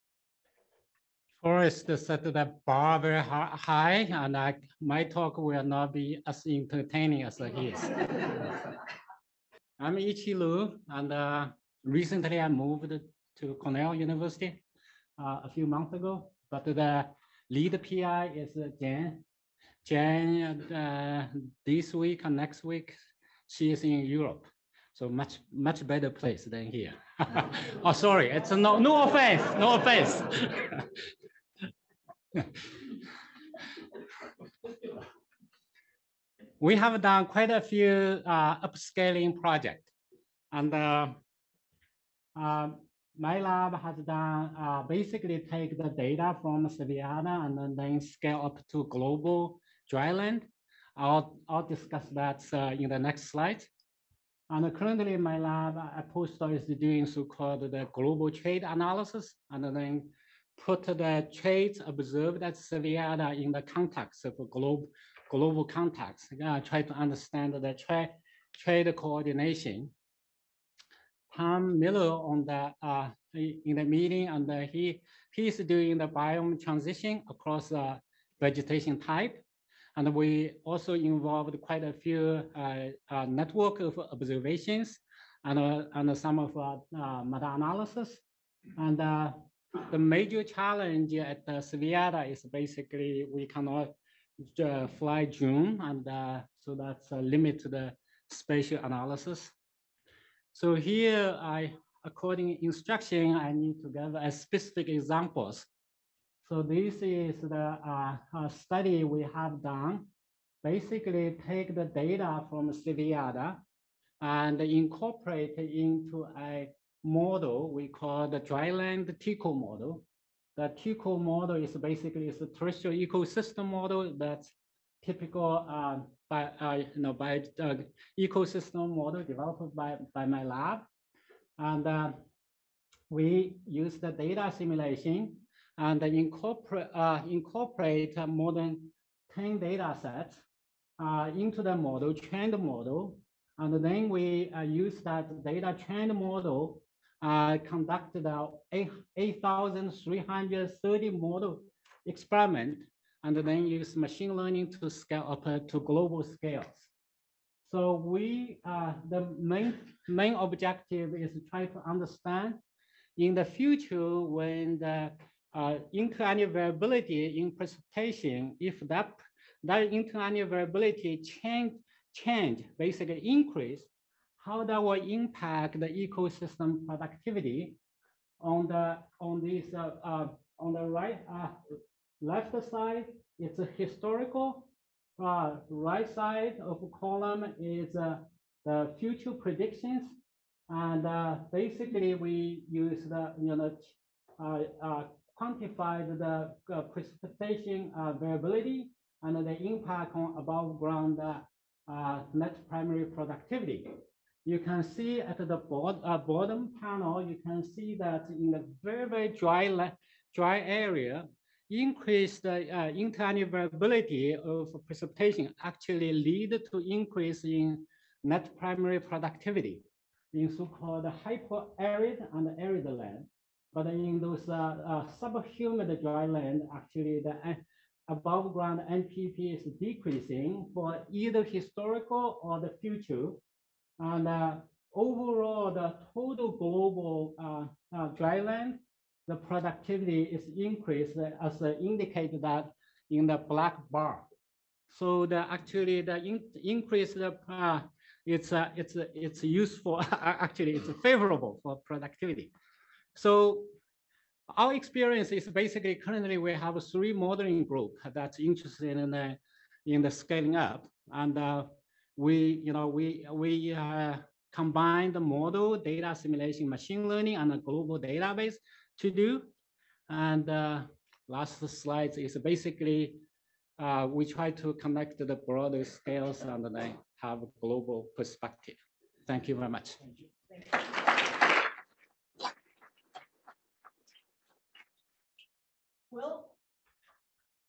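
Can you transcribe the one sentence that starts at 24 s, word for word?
So much, much better place than here.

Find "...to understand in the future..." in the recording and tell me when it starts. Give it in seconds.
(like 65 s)
161 s.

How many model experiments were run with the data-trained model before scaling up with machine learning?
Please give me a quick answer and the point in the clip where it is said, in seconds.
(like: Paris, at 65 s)
8,330, at 148 s.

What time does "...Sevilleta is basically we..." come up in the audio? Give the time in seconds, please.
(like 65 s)
91 s.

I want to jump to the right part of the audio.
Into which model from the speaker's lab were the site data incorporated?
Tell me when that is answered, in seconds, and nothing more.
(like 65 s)
118 s.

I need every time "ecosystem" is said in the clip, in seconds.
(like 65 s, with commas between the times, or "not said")
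122 s, 128 s, 175 s.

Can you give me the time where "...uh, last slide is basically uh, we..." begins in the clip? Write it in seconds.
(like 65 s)
270 s.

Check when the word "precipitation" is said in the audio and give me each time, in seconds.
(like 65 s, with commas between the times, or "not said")
167 s, 196 s, 214 s.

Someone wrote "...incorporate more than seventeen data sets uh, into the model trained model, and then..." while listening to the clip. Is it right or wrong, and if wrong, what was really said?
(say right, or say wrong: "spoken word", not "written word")
wrong: "ten", not "seventeen".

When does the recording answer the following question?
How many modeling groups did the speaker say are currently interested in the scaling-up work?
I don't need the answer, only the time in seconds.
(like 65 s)
256 s.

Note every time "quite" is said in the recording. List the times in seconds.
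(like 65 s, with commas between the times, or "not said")
37 s, 81 s.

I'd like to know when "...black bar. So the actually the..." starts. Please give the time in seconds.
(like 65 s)
243 s.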